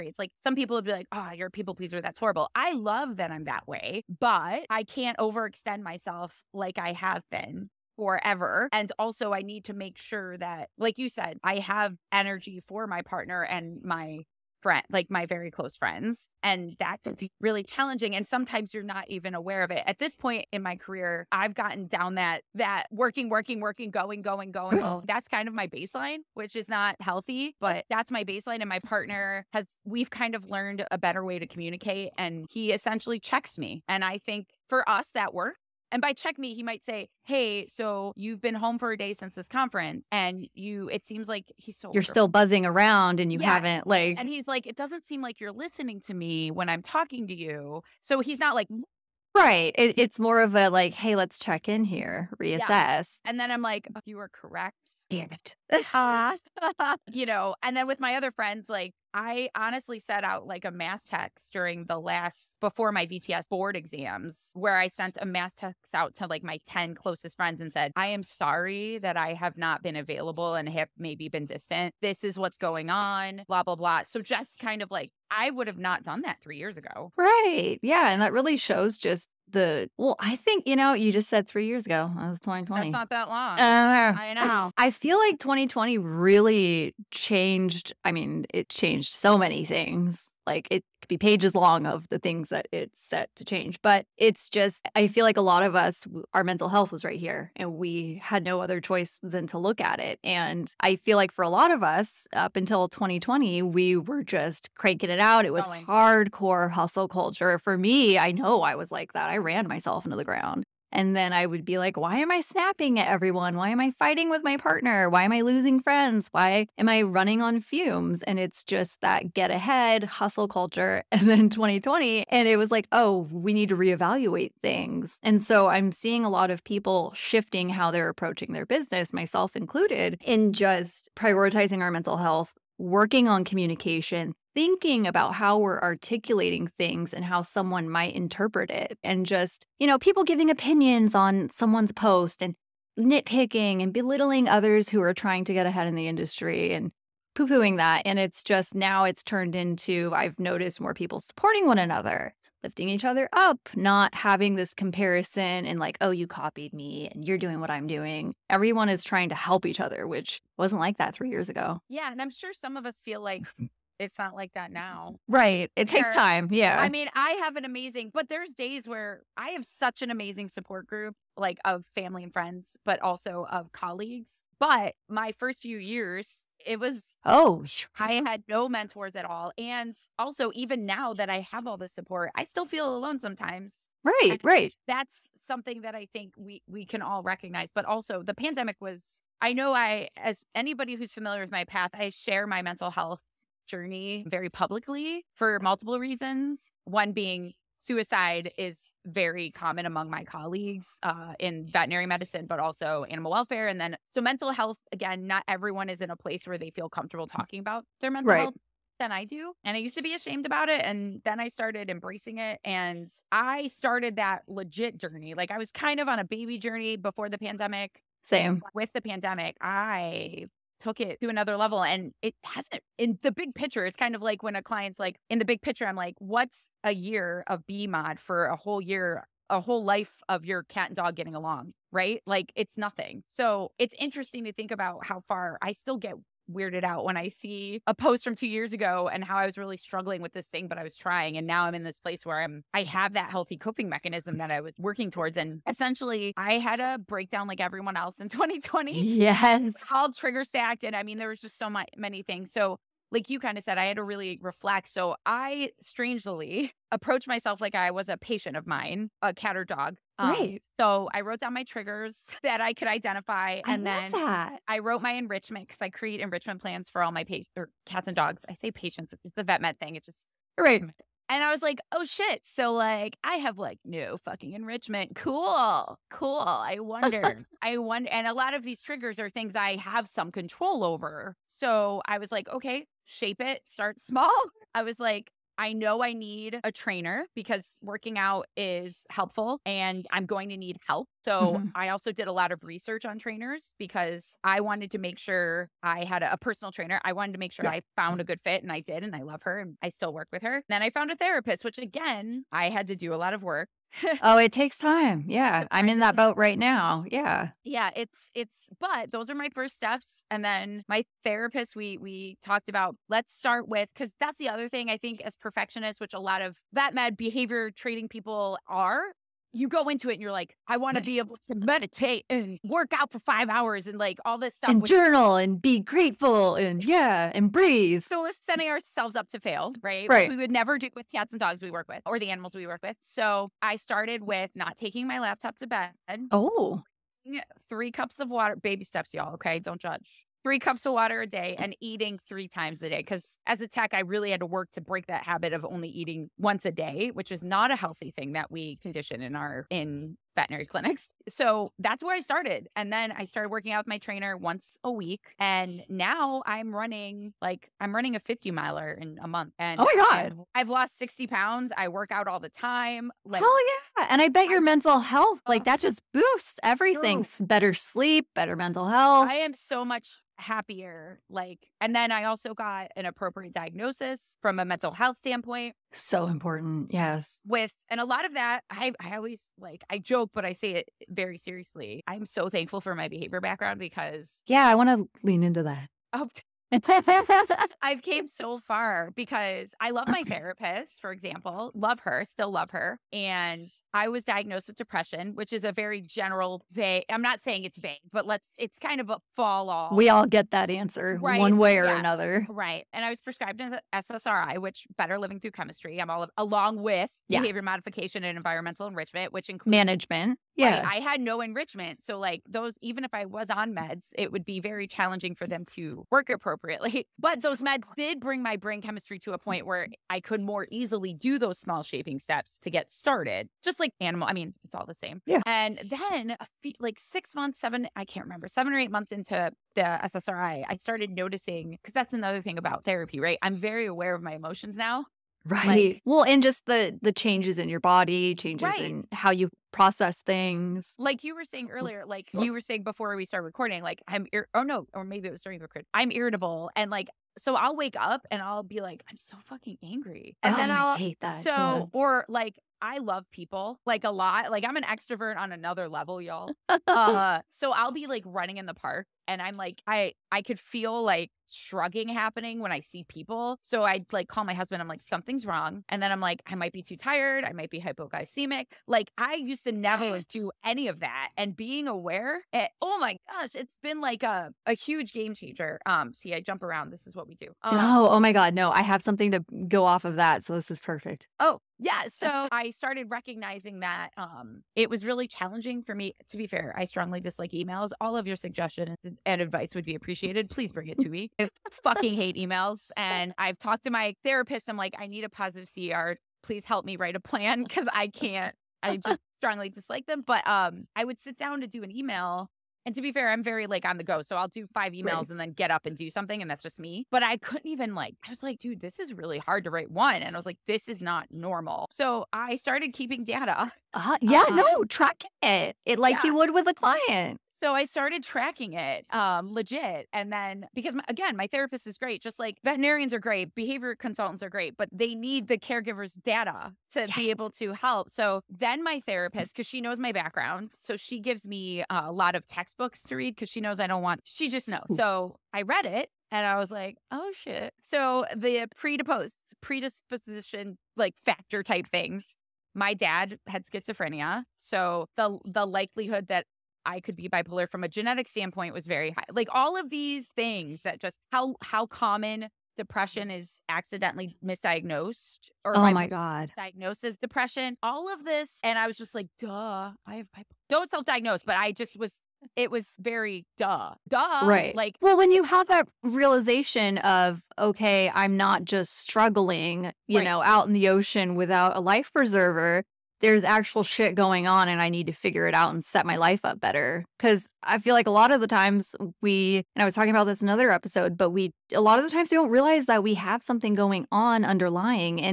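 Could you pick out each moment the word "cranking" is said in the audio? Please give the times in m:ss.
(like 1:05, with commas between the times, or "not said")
1:44.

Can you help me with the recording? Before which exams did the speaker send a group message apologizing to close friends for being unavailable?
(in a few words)
VTS board exams.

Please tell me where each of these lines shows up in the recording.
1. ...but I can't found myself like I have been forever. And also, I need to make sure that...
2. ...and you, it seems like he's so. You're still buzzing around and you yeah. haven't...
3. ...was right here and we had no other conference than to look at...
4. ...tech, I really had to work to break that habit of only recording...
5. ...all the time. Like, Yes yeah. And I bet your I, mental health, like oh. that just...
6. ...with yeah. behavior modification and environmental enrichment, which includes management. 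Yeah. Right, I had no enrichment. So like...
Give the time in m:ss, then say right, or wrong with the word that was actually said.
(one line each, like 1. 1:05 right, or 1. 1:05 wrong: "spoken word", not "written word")
1. 0:04 wrong: "overextend", not "found"
2. 0:40 right
3. 1:36 wrong: "choice", not "conference"
4. 5:43 wrong: "eating", not "recording"
5. 6:02 wrong: "Hell", not "Yes"
6. 6:46 right.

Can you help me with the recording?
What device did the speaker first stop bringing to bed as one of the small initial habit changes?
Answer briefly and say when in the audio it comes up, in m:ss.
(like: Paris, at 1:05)
Laptop, at 5:35.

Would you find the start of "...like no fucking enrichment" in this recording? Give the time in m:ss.
4:33.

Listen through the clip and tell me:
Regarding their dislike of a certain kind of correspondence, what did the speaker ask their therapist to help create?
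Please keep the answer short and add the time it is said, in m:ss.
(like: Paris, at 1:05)
A positive CR, at 8:15.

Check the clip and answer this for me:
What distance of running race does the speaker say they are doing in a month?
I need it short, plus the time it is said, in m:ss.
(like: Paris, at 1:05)
50 miler, at 5:58.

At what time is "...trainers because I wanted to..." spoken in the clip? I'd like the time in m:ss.
4:53.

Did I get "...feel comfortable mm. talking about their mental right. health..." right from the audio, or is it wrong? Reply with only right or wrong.
right.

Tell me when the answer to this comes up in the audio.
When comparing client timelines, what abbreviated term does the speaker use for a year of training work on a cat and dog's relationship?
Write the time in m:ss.
3:47.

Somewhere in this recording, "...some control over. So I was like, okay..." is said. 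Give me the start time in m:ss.
4:40.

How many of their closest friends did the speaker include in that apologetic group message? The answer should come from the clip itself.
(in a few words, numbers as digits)
10.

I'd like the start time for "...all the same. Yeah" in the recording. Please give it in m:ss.
7:04.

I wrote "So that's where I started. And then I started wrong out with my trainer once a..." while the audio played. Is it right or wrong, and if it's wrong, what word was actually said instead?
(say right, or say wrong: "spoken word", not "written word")
wrong: "working", not "wrong".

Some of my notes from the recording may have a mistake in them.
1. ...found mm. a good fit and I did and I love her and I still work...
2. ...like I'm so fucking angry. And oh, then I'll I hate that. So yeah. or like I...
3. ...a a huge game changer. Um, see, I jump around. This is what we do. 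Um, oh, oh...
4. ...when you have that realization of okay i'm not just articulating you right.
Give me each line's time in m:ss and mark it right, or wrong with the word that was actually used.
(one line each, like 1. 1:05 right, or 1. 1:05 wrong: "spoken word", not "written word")
1. 4:57 right
2. 7:28 right
3. 7:54 right
4. 9:25 wrong: "struggling", not "articulating".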